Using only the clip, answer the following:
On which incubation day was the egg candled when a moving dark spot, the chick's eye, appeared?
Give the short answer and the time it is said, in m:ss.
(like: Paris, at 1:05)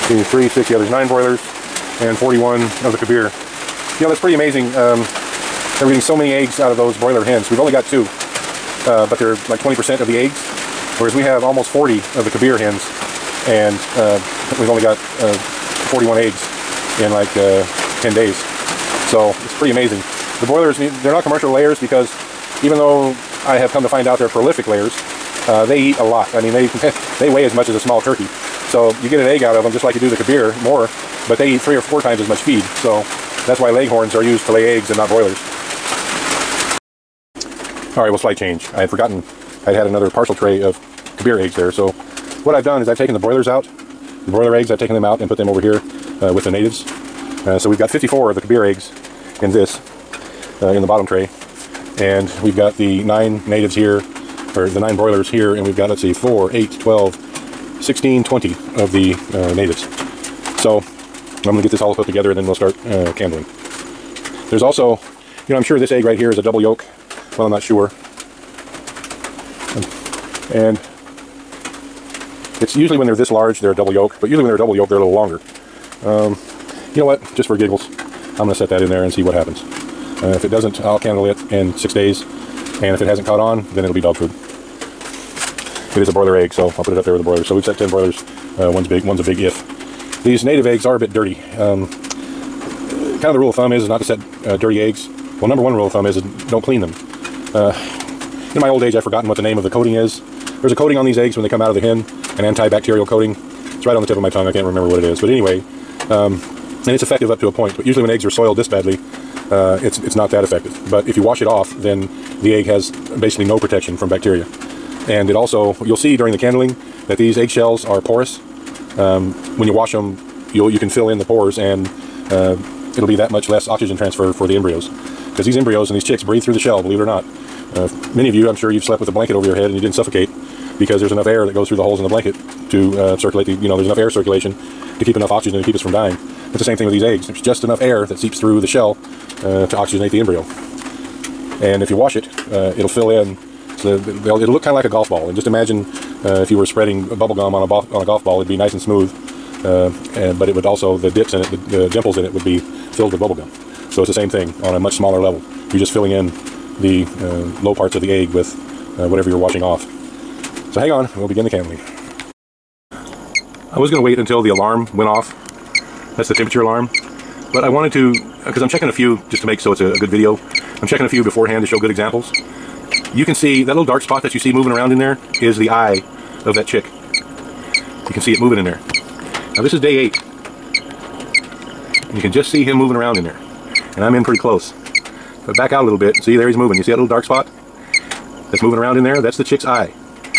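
Day 8, at 2:59.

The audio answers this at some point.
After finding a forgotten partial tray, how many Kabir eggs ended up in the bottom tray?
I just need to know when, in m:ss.
0:47.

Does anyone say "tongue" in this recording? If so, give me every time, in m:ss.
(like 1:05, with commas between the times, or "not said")
1:44.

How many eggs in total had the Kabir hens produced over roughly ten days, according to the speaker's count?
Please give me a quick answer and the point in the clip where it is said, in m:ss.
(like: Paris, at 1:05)
41, at 0:15.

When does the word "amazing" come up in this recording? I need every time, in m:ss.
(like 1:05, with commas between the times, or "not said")
0:04, 0:19.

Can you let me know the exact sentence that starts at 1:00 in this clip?
So I'm going to get this all put together and then we'll start uh, candling.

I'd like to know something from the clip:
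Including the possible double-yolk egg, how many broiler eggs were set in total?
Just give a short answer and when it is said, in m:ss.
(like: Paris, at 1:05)
10, at 1:27.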